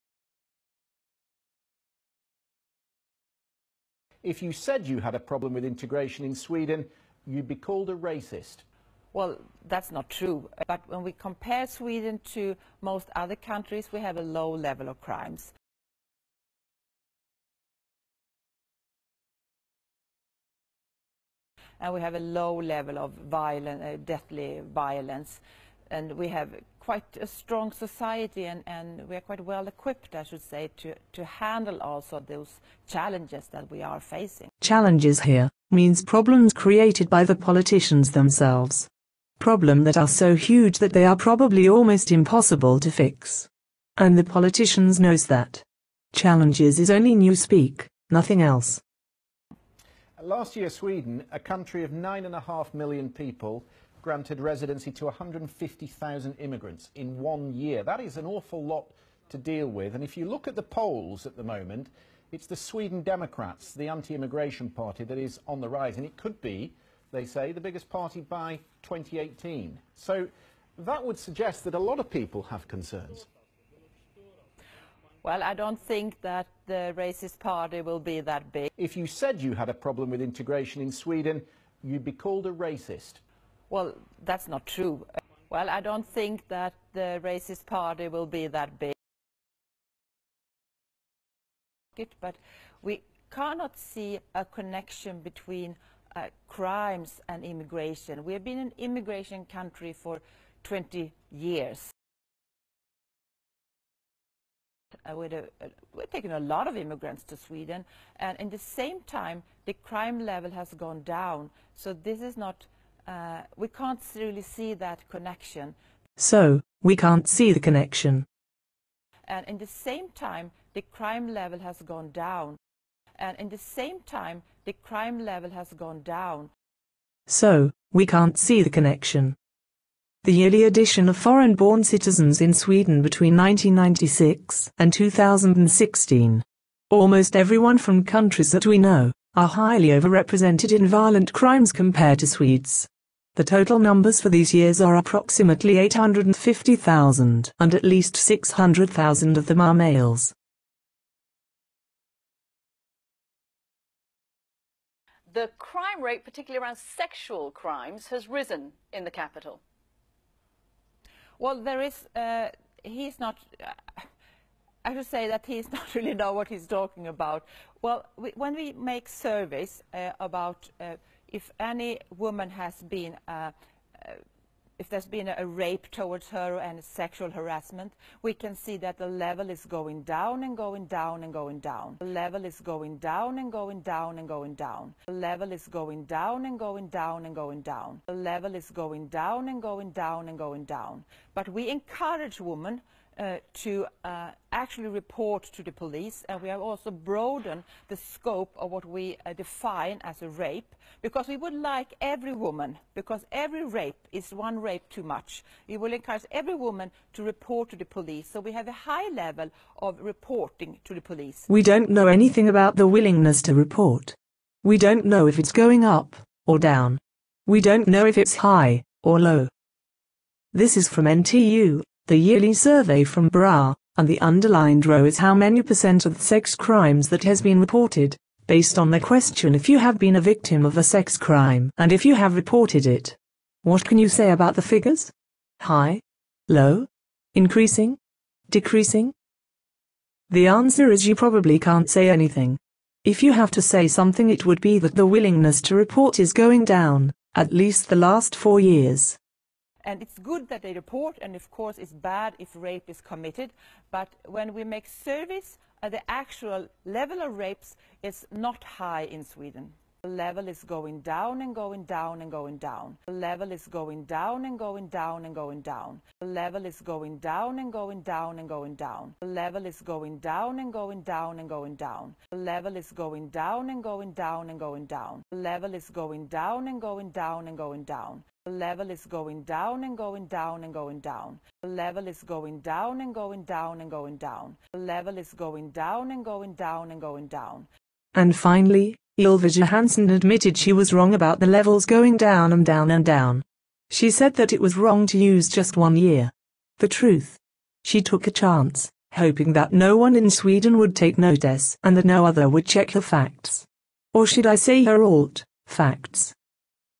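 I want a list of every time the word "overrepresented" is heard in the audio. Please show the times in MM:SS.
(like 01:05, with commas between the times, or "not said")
02:19.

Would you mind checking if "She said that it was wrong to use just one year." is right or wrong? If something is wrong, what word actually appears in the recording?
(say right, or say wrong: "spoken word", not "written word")
right.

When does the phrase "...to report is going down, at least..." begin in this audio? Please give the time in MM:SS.
04:05.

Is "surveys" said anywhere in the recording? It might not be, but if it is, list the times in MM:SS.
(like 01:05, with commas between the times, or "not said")
02:49, 03:42, 04:14.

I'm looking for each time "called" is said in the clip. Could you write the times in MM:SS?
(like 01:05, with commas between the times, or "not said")
00:07, 01:22.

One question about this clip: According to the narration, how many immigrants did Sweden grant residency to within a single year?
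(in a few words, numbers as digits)
150,000.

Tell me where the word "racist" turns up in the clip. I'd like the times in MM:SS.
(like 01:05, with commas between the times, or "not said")
00:07, 01:16, 01:22, 01:27.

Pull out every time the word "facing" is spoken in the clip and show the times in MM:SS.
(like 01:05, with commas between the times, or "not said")
00:34.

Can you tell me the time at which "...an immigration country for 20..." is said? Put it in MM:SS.
01:38.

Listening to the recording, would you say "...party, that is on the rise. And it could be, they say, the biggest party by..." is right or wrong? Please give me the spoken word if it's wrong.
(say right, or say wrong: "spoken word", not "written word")
right.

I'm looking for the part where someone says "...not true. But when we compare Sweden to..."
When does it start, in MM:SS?
00:09.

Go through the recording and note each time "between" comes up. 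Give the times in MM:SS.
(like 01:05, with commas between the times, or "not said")
01:35, 02:13.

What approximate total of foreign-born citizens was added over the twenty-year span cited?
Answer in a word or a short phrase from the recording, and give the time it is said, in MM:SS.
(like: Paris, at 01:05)
850,000, at 02:25.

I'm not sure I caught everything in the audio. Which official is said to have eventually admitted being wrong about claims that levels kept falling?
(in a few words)
Ylva Johansson.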